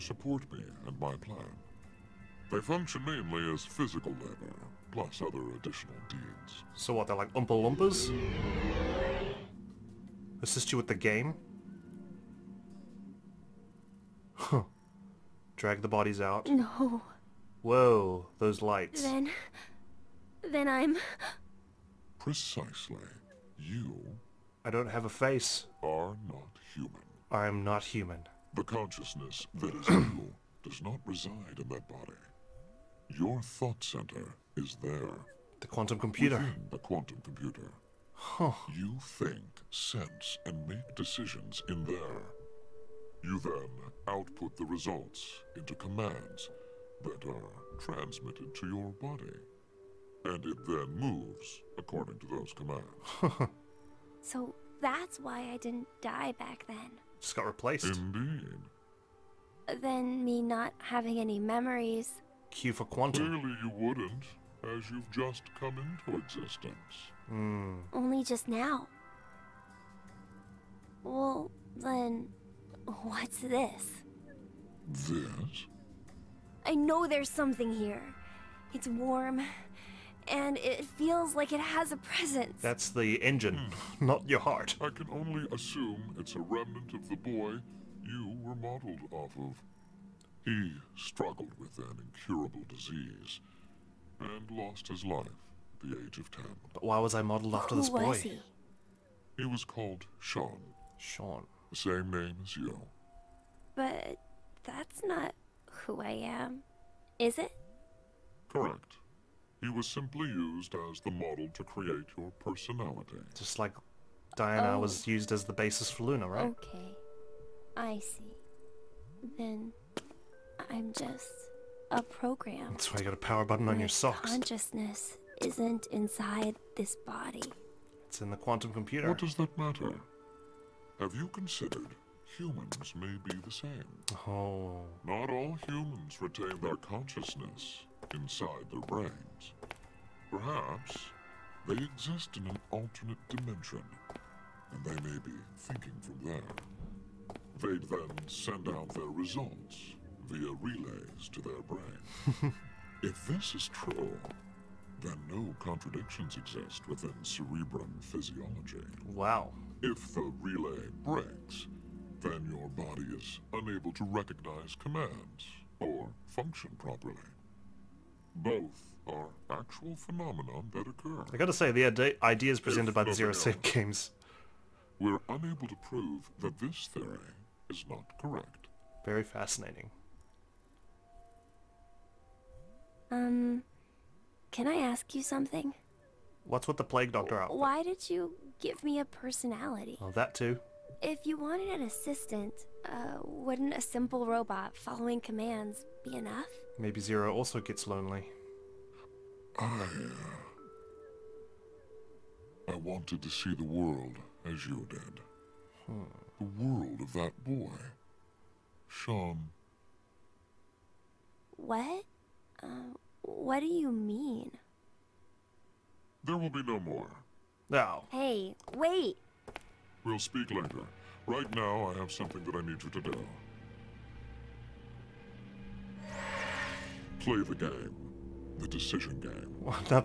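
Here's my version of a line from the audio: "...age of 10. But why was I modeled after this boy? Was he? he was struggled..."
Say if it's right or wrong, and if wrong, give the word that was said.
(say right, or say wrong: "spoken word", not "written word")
wrong: "called", not "struggled".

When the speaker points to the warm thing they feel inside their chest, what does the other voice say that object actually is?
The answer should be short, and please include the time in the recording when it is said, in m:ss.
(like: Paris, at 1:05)
The engine, at 1:22.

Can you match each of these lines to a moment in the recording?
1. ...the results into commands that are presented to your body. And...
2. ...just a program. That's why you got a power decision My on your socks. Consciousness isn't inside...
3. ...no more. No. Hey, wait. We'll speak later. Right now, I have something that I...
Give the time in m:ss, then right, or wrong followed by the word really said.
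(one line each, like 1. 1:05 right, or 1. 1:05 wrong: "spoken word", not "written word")
1. 0:44 wrong: "transmitted", not "presented"
2. 2:00 wrong: "button", not "decision"
3. 3:36 right.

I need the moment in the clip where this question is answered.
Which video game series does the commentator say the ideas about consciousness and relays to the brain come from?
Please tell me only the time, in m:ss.
2:53.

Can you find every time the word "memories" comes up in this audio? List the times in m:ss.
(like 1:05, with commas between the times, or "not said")
1:01.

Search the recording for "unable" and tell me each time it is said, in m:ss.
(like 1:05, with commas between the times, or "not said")
2:43, 2:55.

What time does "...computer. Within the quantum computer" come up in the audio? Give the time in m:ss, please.
0:35.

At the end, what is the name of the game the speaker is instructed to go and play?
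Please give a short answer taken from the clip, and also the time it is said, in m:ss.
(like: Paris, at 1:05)
The decision game, at 3:48.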